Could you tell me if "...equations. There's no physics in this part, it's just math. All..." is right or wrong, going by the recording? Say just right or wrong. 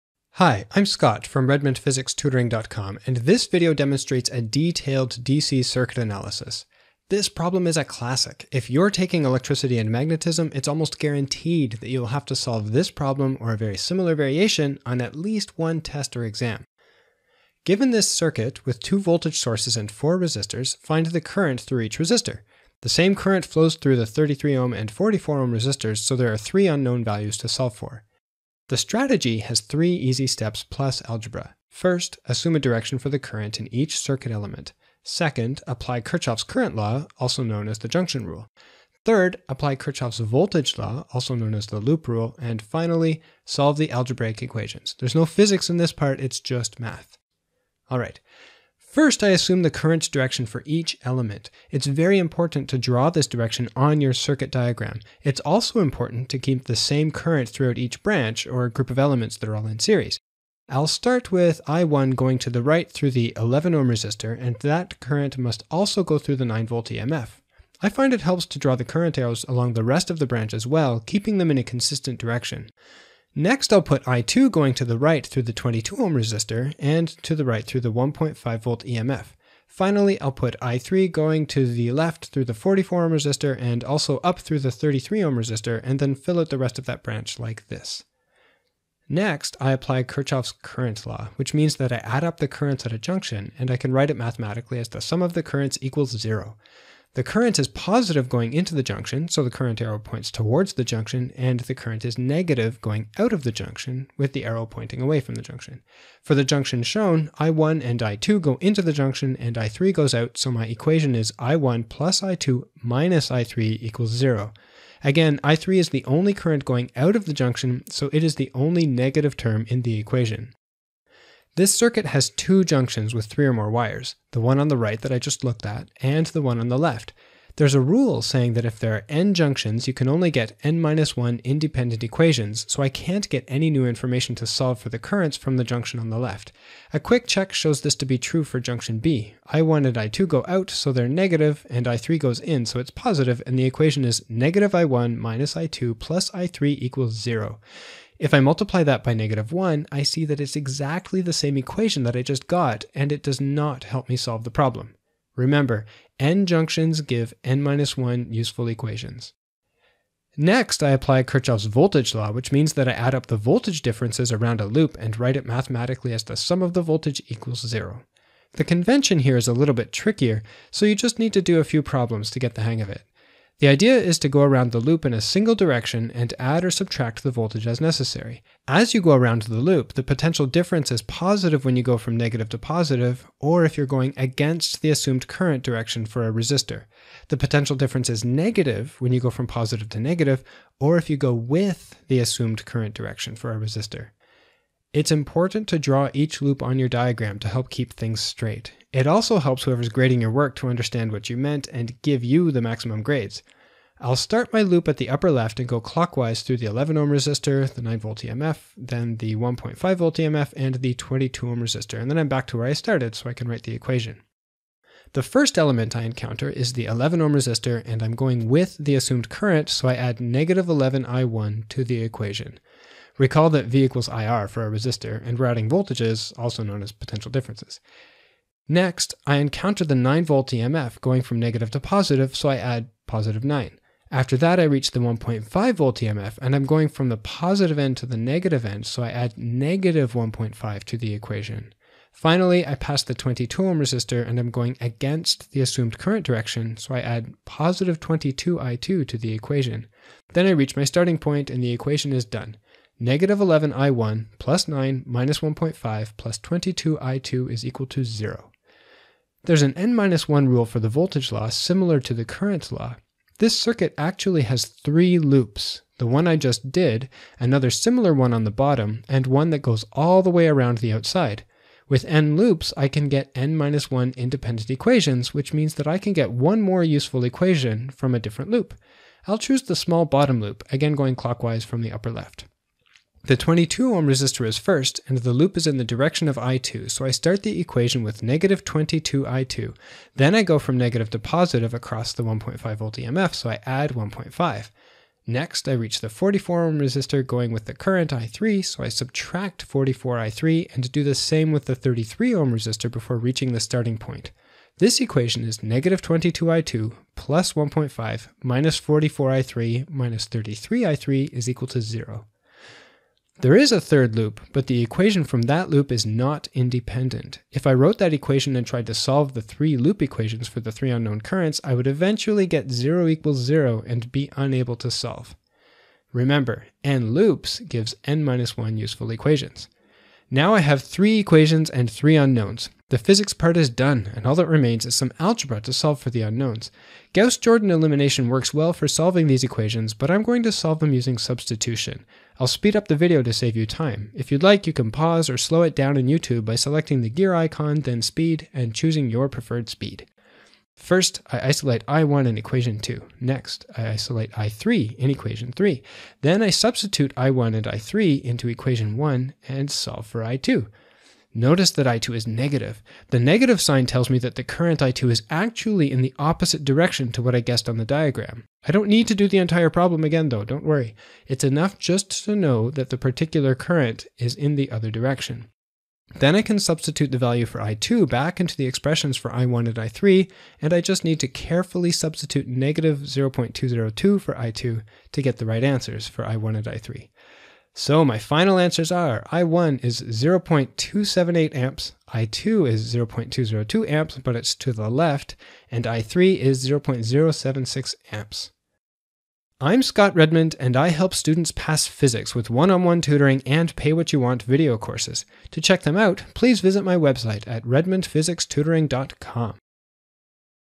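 right.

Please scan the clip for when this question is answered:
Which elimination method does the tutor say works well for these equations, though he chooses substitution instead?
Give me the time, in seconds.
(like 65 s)
337 s.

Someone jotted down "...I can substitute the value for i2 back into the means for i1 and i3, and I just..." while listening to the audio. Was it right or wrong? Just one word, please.
wrong.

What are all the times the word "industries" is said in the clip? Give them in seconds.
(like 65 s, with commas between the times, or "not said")
not said.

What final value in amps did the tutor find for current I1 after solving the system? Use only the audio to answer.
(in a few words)
0.278 amps.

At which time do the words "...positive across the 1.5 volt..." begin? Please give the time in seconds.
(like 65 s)
291 s.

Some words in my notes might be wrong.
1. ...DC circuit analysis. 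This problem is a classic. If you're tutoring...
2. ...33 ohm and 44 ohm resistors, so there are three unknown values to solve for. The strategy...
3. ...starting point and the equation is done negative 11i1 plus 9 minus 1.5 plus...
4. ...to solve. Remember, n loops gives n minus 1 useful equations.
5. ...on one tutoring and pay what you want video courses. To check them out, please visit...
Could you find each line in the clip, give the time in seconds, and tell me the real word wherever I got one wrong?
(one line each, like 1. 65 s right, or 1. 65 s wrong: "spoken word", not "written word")
1. 5 s wrong: "taking", not "tutoring"
2. 24 s right
3. 250 s right
4. 324 s right
5. 402 s right.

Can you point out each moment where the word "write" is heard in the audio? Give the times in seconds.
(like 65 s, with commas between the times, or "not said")
93 s, 165 s, 213 s.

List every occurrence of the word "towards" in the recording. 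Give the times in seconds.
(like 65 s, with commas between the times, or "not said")
100 s.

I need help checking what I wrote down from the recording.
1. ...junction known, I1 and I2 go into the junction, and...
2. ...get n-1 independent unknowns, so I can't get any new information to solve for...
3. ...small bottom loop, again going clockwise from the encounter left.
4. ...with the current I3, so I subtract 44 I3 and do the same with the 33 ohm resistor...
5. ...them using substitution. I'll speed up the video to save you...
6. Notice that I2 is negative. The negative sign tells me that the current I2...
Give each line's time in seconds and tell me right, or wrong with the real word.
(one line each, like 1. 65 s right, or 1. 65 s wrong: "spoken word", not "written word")
1. 106 s wrong: "shown", not "known"
2. 130 s wrong: "equations", not "unknowns"
3. 279 s wrong: "upper", not "encounter"
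4. 297 s right
5. 340 s right
6. 361 s right.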